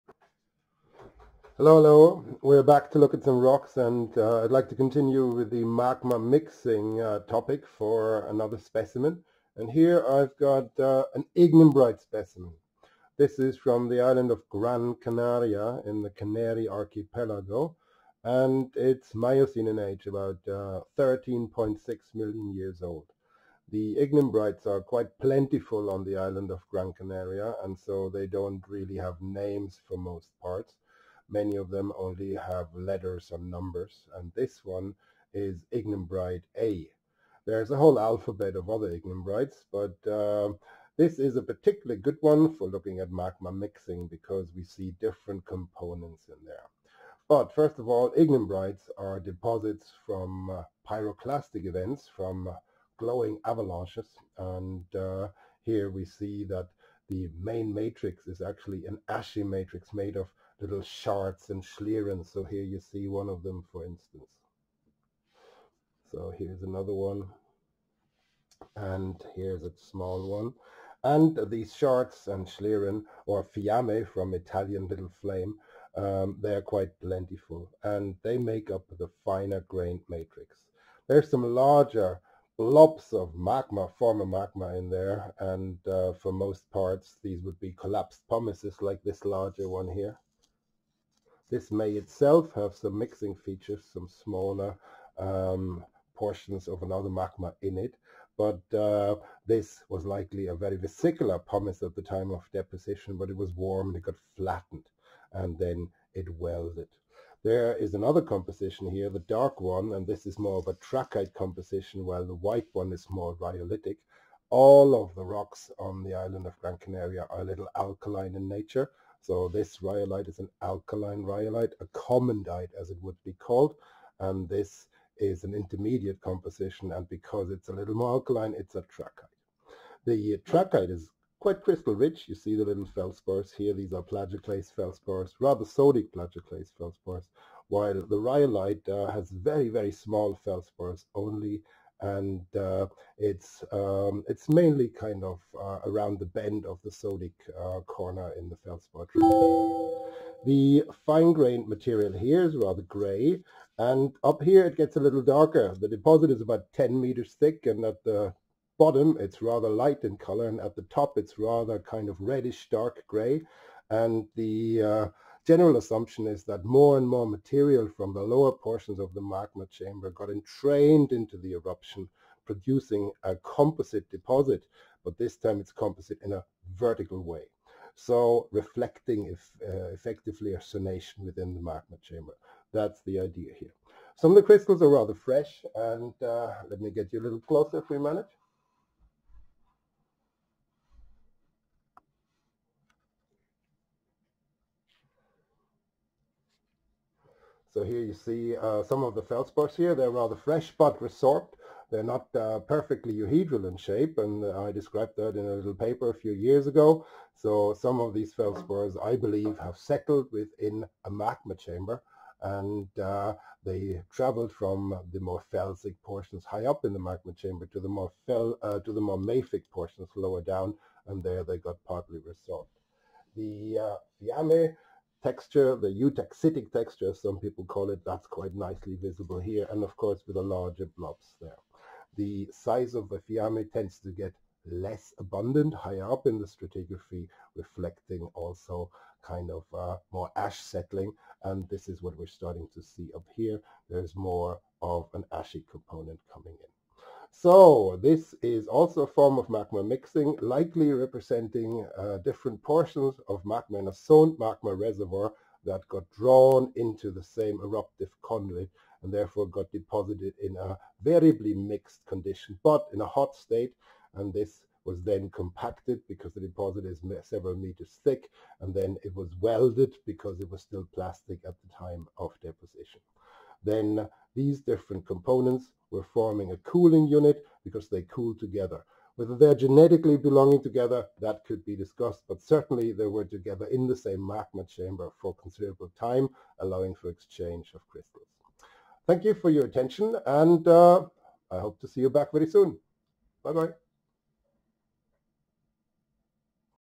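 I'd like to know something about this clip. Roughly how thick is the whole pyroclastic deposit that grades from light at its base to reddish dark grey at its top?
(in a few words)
10 meters.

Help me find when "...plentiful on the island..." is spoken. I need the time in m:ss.
0:25.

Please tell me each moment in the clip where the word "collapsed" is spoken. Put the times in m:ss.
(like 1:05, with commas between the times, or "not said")
1:27.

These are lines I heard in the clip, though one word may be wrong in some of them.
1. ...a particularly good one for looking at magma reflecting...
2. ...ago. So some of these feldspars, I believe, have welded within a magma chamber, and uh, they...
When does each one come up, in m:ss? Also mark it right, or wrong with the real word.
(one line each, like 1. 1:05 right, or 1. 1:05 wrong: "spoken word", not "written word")
1. 0:41 wrong: "mixing", not "reflecting"
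2. 3:26 wrong: "settled", not "welded".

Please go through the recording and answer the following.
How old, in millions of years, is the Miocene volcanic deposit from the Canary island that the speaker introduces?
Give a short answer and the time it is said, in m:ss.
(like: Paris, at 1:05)
13.6 million years, at 0:20.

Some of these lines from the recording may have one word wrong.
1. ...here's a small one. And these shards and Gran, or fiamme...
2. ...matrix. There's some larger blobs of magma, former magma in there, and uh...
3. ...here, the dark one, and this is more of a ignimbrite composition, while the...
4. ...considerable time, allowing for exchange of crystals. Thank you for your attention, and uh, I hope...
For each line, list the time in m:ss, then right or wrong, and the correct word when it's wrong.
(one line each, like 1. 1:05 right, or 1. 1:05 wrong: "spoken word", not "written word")
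1. 1:09 wrong: "Schlieren", not "Gran"
2. 1:20 right
3. 1:48 wrong: "trachyte", not "ignimbrite"
4. 4:45 right.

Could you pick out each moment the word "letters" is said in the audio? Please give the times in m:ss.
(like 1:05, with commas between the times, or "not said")
0:32.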